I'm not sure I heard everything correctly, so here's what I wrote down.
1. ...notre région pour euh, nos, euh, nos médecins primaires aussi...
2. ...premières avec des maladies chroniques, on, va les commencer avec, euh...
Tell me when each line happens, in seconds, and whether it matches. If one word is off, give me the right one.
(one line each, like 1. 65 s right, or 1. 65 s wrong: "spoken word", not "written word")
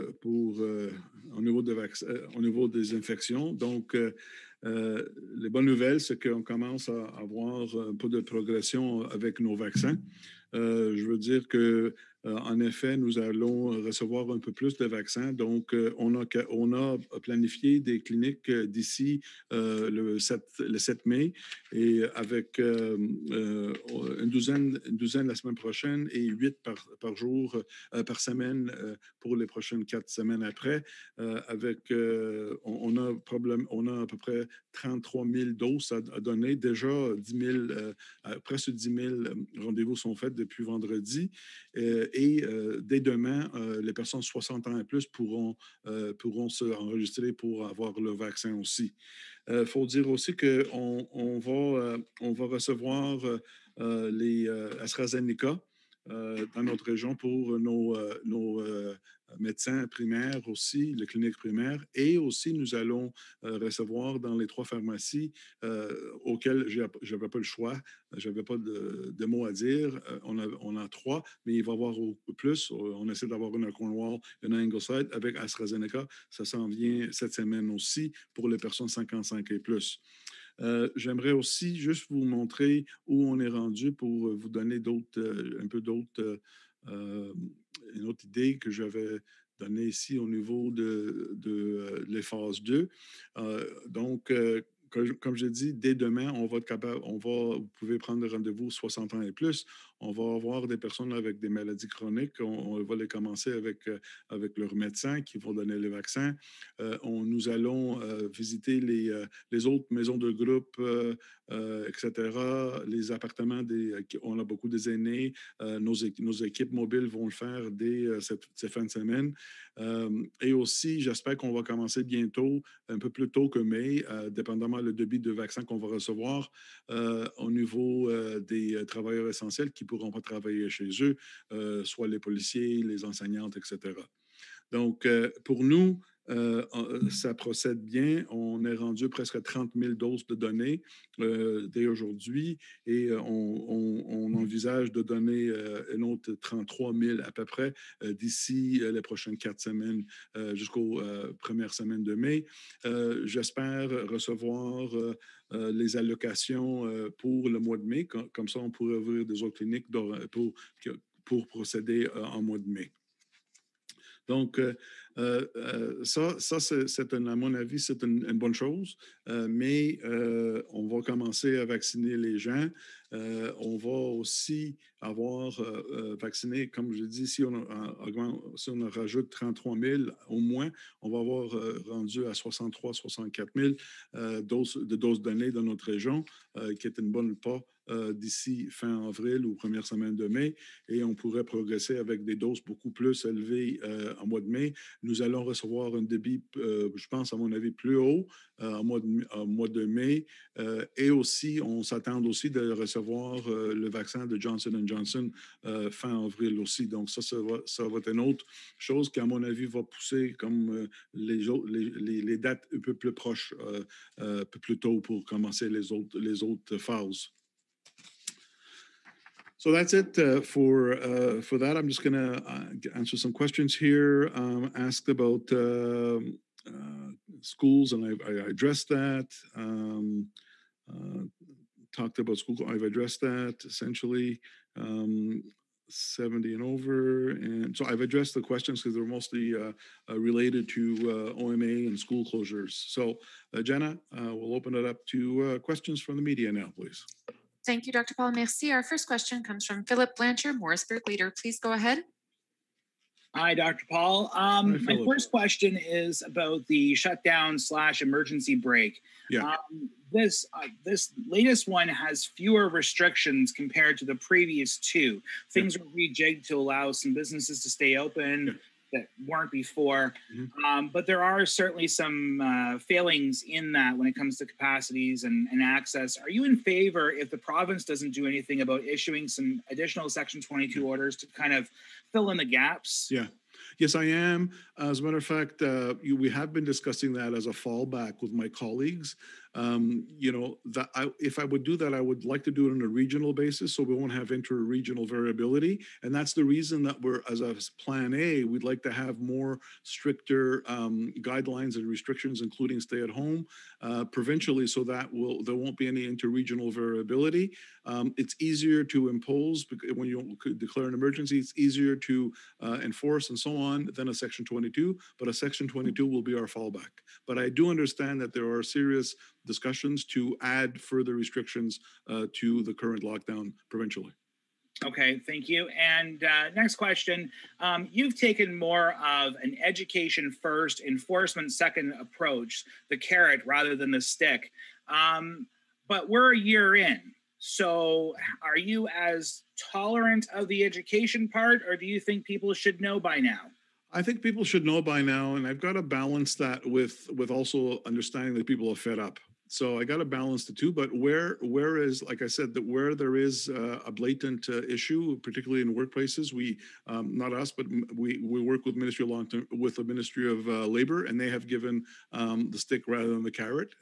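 1. 56 s right
2. 100 s wrong: "personnes", not "premières".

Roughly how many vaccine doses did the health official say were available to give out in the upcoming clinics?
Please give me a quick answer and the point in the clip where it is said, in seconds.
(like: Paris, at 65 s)
33,000, at 34 s.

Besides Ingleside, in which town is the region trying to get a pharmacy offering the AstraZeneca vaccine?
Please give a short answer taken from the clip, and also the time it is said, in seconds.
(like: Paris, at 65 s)
Cornwall, at 73 s.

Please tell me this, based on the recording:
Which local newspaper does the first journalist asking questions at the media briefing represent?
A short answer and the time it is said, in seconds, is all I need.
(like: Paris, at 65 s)
Morrisburg Leader, at 250 s.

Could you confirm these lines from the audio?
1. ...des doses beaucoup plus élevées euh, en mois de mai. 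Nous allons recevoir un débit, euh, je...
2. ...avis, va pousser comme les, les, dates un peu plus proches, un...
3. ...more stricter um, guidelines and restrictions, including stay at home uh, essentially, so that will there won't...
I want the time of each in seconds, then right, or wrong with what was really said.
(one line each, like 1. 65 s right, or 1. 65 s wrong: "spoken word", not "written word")
1. 192 s right
2. 209 s right
3. 299 s wrong: "provincially", not "essentially".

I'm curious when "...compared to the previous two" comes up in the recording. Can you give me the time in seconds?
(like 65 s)
263 s.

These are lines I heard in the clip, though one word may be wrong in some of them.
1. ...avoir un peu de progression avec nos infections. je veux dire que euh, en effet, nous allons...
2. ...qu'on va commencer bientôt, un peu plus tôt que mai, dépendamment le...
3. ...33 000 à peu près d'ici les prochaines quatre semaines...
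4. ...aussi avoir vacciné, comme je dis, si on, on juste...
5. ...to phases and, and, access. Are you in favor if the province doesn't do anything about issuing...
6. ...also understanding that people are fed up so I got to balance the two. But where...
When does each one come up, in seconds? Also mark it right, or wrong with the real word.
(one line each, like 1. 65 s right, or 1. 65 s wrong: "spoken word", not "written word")
1. 7 s wrong: "vaccins", not "infections"
2. 121 s right
3. 146 s right
4. 173 s wrong: "rajoute", not "juste"
5. 274 s wrong: "capacities", not "phases"
6. 347 s right.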